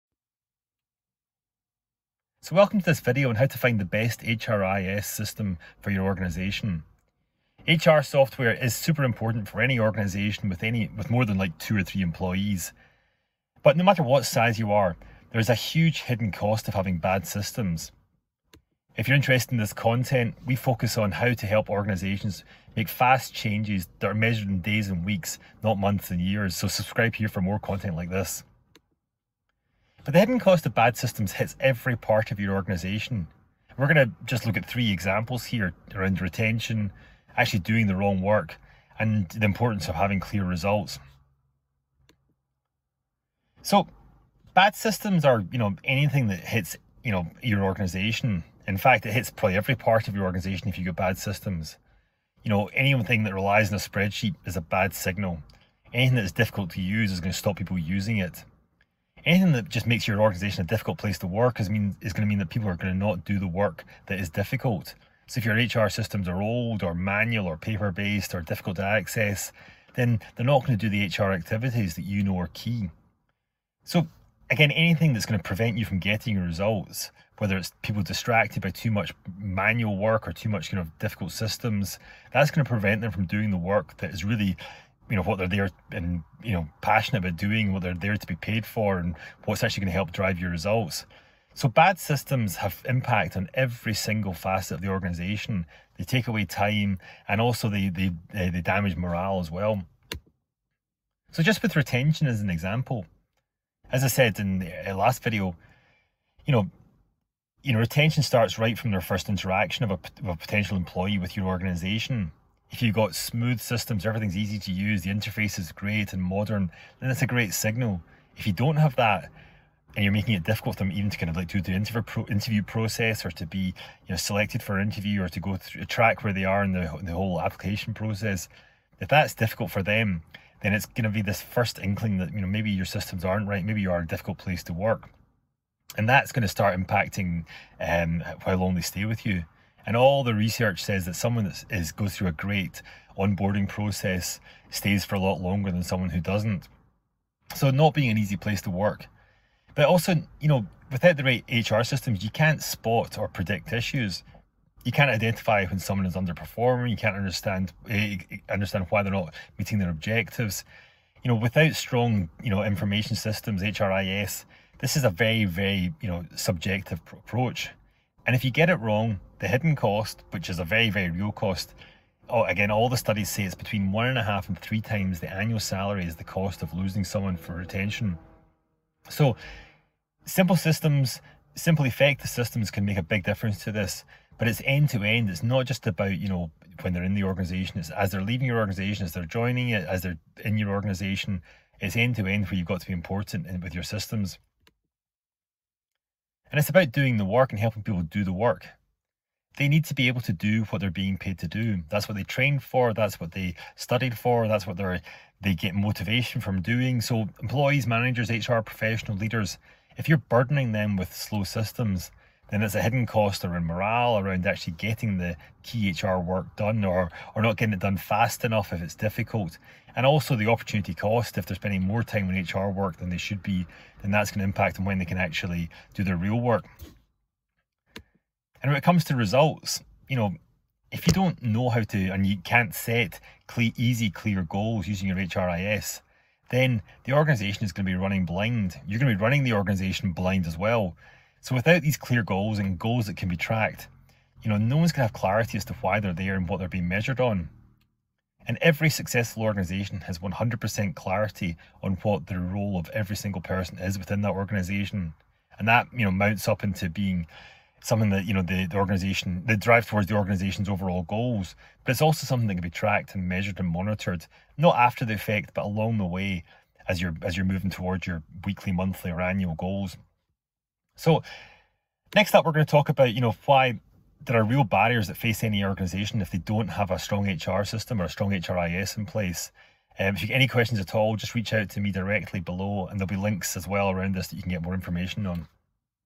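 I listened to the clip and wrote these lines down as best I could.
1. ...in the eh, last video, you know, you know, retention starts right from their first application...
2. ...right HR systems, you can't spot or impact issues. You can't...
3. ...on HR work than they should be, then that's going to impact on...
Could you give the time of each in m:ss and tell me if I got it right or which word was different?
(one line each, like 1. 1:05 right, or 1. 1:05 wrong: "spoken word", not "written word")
1. 1:44 wrong: "interaction", not "application"
2. 2:31 wrong: "predict", not "impact"
3. 3:42 right.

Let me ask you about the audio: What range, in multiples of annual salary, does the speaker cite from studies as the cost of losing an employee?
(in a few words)
1.5 to 3 times.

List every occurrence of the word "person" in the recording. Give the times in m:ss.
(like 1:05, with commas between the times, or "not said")
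4:13.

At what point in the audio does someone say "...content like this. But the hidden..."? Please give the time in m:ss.
0:27.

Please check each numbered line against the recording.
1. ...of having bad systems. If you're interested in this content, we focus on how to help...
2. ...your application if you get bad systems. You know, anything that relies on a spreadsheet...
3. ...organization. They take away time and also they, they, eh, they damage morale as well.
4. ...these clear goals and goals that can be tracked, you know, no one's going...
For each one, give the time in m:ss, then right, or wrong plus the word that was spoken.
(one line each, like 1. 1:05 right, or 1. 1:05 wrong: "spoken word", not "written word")
1. 0:16 right
2. 0:50 wrong: "organisation", not "application"
3. 1:34 right
4. 4:01 right.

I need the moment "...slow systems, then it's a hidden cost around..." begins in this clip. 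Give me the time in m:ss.
3:31.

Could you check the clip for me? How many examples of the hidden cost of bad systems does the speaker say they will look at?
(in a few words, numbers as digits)
3.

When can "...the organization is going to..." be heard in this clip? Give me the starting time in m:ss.
3:57.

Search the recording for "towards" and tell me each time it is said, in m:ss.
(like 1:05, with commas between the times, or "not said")
4:19, 4:27.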